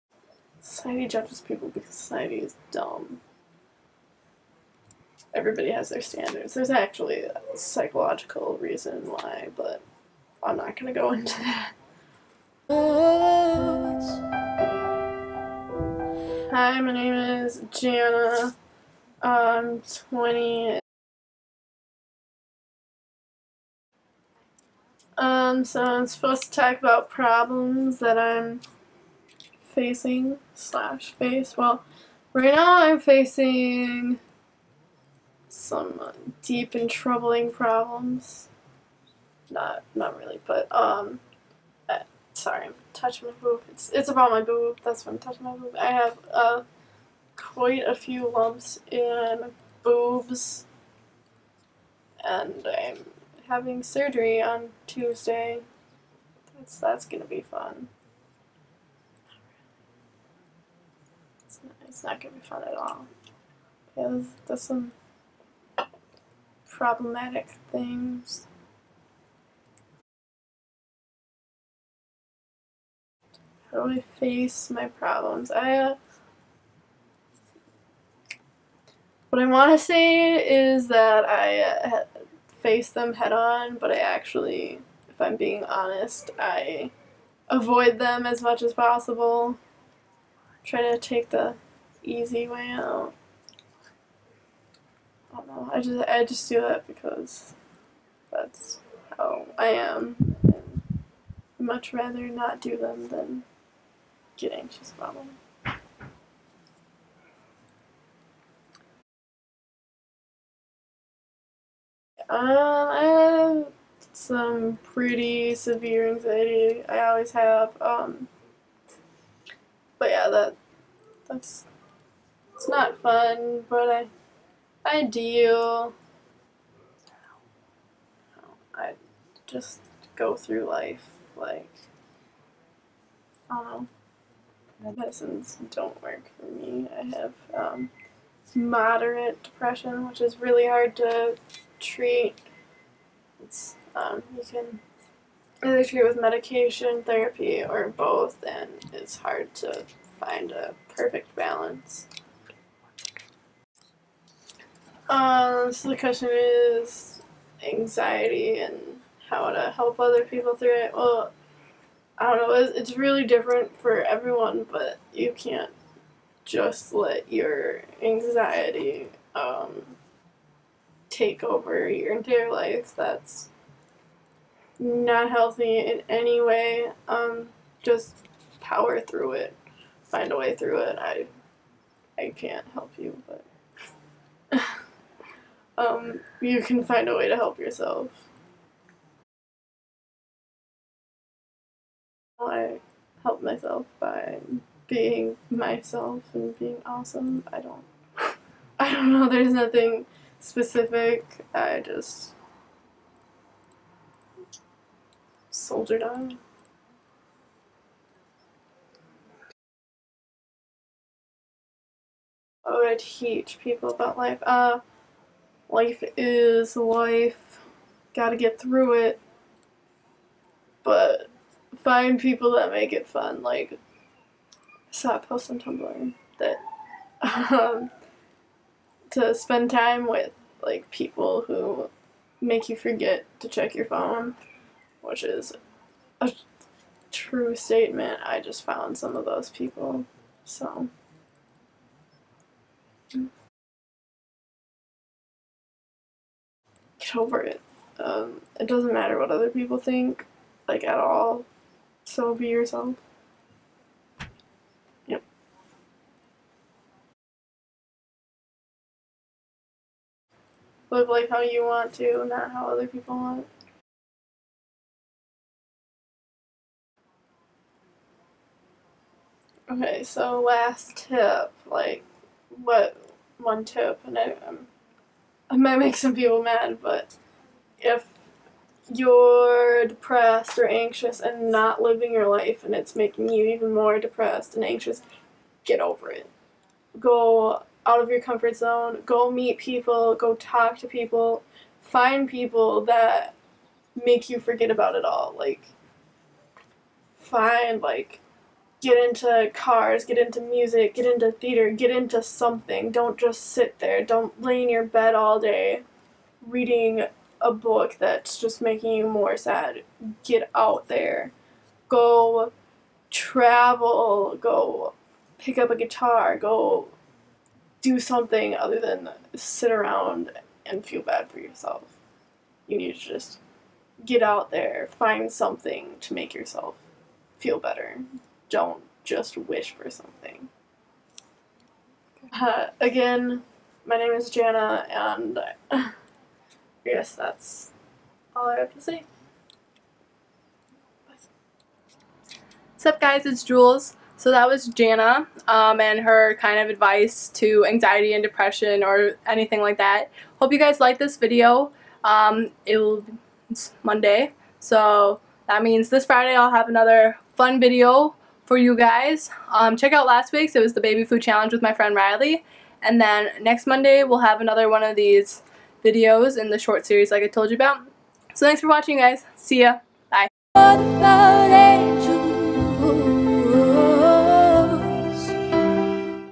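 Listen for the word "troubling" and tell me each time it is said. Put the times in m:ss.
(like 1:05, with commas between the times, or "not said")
0:36.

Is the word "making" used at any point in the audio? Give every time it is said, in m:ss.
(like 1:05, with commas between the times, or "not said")
4:42, 5:08.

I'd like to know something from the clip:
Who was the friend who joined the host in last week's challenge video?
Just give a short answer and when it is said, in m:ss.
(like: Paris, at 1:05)
Riley, at 6:01.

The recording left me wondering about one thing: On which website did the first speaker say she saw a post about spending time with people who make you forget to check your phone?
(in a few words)
Tumblr.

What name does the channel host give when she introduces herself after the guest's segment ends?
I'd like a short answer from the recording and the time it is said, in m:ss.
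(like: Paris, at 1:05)
Jules, at 5:43.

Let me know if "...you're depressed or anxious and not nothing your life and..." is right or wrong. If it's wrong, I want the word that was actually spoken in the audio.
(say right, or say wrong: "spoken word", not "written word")
wrong: "living", not "nothing".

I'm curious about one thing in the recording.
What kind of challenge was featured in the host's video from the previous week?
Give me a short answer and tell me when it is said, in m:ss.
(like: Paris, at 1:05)
Baby food challenge, at 6:00.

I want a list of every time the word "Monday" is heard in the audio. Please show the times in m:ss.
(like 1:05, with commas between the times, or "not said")
5:53, 6:03.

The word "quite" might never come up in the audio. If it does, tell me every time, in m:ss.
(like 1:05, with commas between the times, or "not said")
0:47.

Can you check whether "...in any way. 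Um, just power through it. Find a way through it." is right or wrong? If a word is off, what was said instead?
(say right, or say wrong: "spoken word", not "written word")
right.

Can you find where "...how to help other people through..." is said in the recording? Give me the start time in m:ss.
2:39.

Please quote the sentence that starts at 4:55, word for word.
Like, find, like, get into cars, get into music, get into theater, get into something.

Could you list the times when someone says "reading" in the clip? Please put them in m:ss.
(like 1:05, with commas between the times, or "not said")
5:06.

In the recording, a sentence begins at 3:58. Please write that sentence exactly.
I just found some of those people.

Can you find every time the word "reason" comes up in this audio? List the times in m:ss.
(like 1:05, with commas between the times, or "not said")
0:08.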